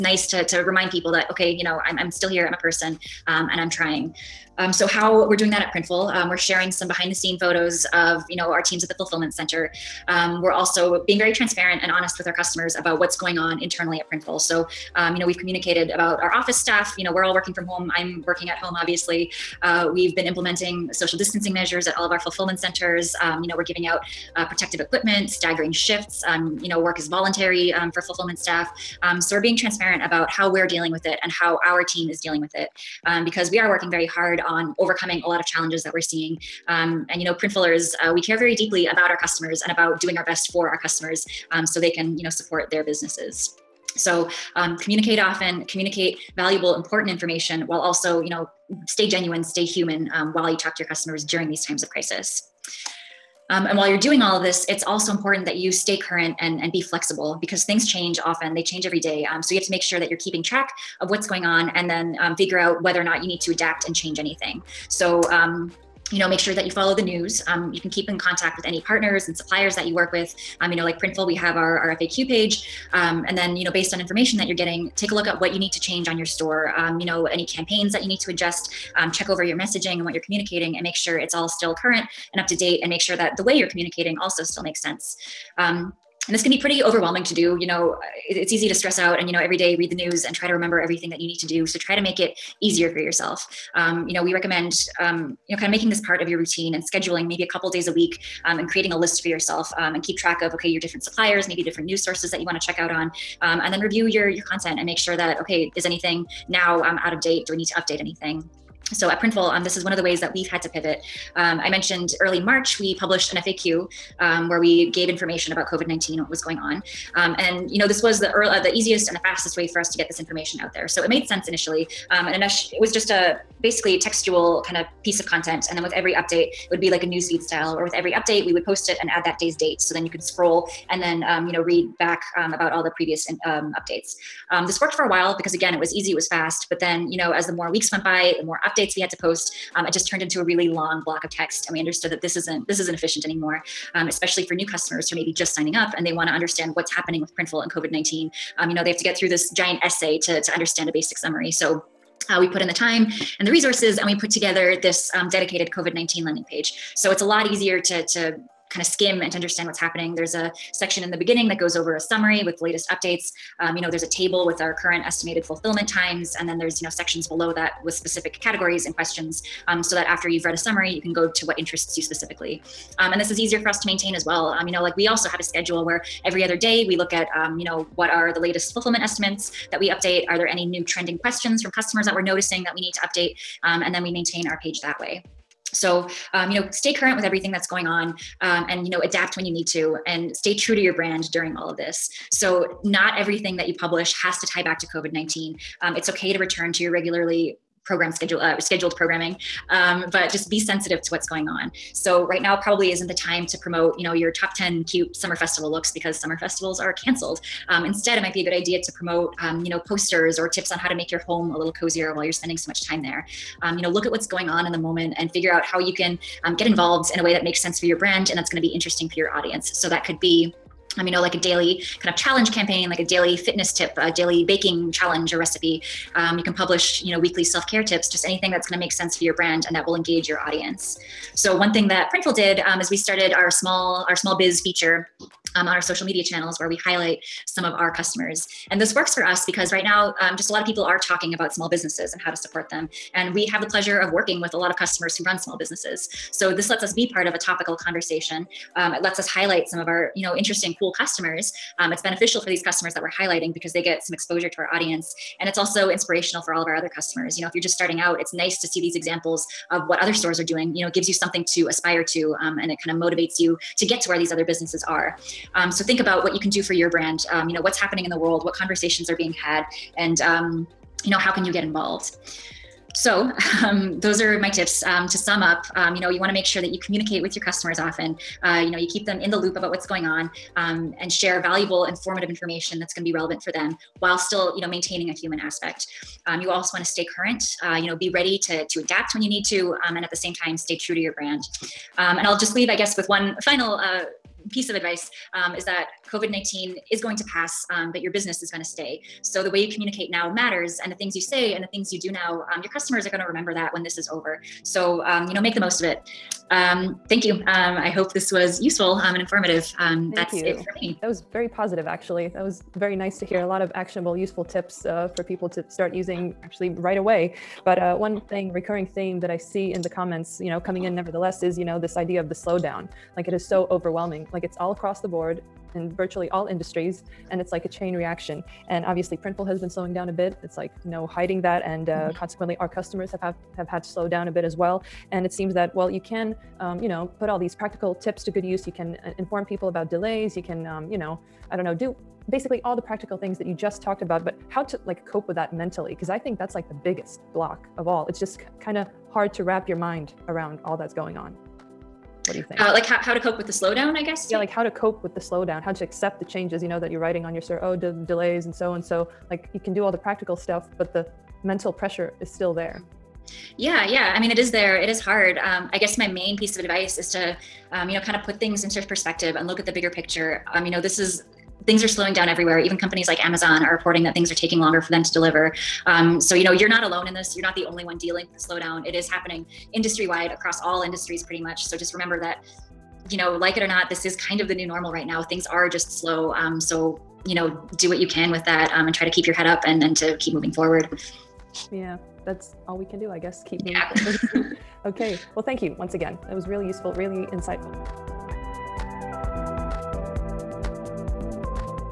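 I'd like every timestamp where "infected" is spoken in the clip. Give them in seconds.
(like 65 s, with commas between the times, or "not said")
not said.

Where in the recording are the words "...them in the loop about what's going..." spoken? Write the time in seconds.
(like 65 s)
279 s.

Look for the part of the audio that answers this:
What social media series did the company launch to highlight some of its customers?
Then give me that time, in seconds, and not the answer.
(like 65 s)
234 s.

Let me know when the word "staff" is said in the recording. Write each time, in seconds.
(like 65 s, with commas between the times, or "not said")
16 s, 28 s.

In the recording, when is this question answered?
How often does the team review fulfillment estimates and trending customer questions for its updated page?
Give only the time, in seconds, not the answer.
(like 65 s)
176 s.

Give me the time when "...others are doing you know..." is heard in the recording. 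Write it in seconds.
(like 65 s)
260 s.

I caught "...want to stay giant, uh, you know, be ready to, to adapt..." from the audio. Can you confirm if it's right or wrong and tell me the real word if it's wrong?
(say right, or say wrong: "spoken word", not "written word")
wrong: "current", not "giant".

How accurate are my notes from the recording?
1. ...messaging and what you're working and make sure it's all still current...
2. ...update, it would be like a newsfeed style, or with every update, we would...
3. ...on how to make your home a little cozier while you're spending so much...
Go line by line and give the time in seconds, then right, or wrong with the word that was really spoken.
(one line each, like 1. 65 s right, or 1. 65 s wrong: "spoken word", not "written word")
1. 79 s wrong: "communicating", not "working"
2. 126 s right
3. 210 s right.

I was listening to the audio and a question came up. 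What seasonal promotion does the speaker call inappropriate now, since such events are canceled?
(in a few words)
Summer festival looks.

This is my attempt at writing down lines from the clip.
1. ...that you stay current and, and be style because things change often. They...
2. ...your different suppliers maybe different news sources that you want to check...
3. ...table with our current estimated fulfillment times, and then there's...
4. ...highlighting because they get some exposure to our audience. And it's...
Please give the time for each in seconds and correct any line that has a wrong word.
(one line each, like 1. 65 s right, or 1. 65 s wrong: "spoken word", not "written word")
1. 55 s wrong: "flexible", not "style"
2. 100 s right
3. 164 s right
4. 253 s right.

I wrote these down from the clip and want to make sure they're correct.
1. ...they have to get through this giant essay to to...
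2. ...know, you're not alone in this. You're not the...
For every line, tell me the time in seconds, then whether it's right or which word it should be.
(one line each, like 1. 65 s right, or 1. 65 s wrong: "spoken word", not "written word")
1. 148 s right
2. 376 s right.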